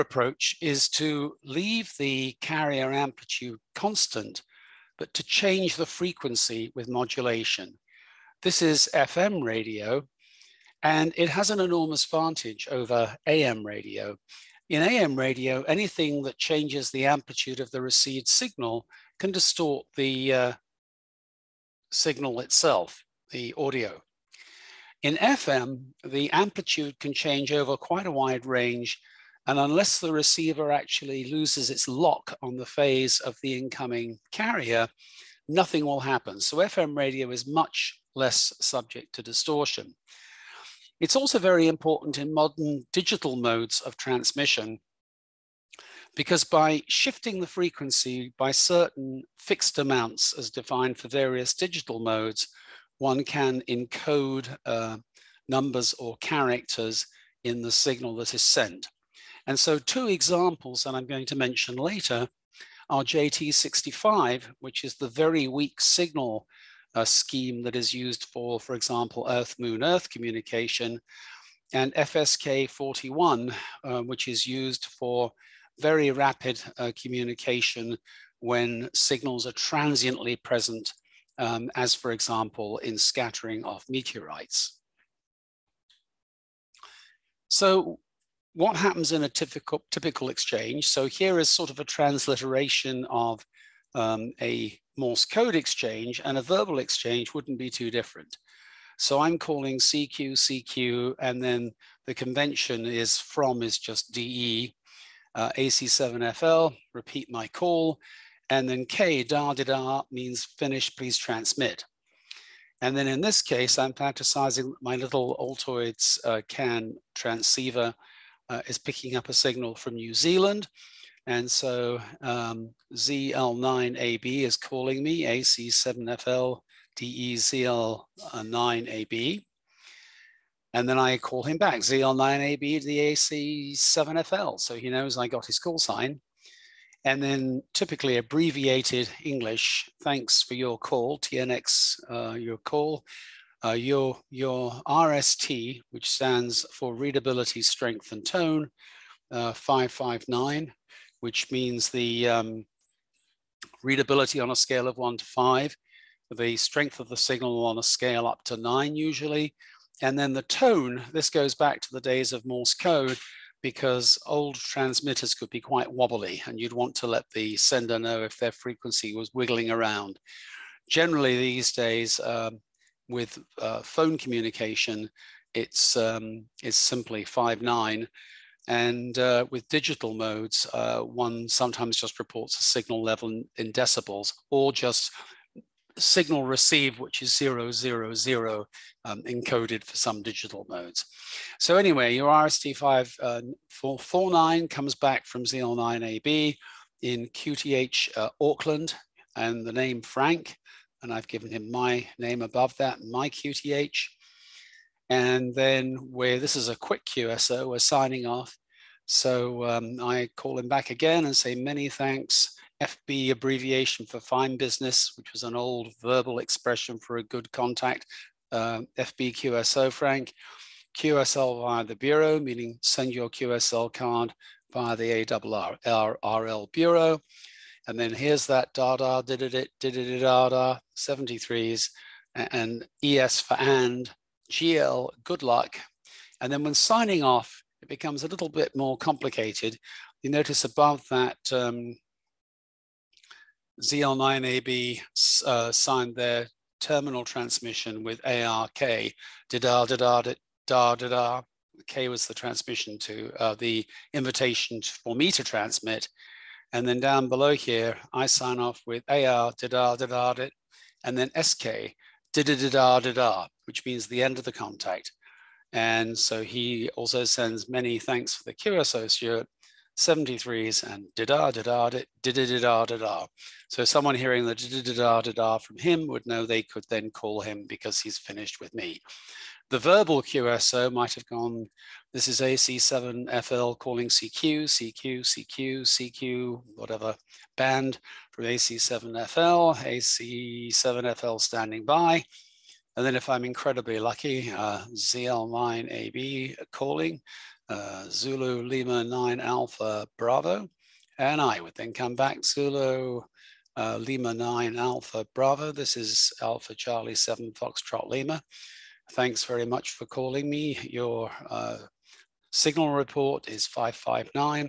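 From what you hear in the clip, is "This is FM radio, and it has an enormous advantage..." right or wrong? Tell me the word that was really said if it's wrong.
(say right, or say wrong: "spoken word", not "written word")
right.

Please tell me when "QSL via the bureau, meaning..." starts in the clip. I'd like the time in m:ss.
3:40.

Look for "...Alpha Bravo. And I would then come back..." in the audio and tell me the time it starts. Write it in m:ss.
4:59.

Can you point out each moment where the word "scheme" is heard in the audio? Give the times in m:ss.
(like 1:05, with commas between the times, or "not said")
1:07.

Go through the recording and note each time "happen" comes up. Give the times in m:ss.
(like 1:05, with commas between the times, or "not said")
0:35, 1:28.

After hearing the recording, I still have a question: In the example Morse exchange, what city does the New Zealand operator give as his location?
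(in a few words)
Auckland.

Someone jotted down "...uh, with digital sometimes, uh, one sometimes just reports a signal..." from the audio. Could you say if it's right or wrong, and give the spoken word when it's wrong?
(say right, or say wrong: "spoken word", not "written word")
wrong: "modes", not "sometimes".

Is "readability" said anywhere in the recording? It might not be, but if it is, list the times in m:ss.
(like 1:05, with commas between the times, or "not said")
2:26, 2:33.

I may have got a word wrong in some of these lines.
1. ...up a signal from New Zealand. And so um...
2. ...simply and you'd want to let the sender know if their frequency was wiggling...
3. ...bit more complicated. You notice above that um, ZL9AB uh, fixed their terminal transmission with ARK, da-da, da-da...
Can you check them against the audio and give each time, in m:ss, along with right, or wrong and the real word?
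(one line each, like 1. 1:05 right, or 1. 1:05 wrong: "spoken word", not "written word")
1. 1:59 right
2. 2:45 wrong: "wobbly", not "simply"
3. 3:58 wrong: "signed", not "fixed".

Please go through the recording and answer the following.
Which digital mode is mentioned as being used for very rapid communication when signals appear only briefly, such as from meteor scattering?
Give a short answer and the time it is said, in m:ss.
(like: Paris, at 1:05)
FSK 41, at 1:11.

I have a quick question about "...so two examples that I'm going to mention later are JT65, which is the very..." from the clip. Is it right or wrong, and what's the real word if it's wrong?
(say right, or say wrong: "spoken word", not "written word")
right.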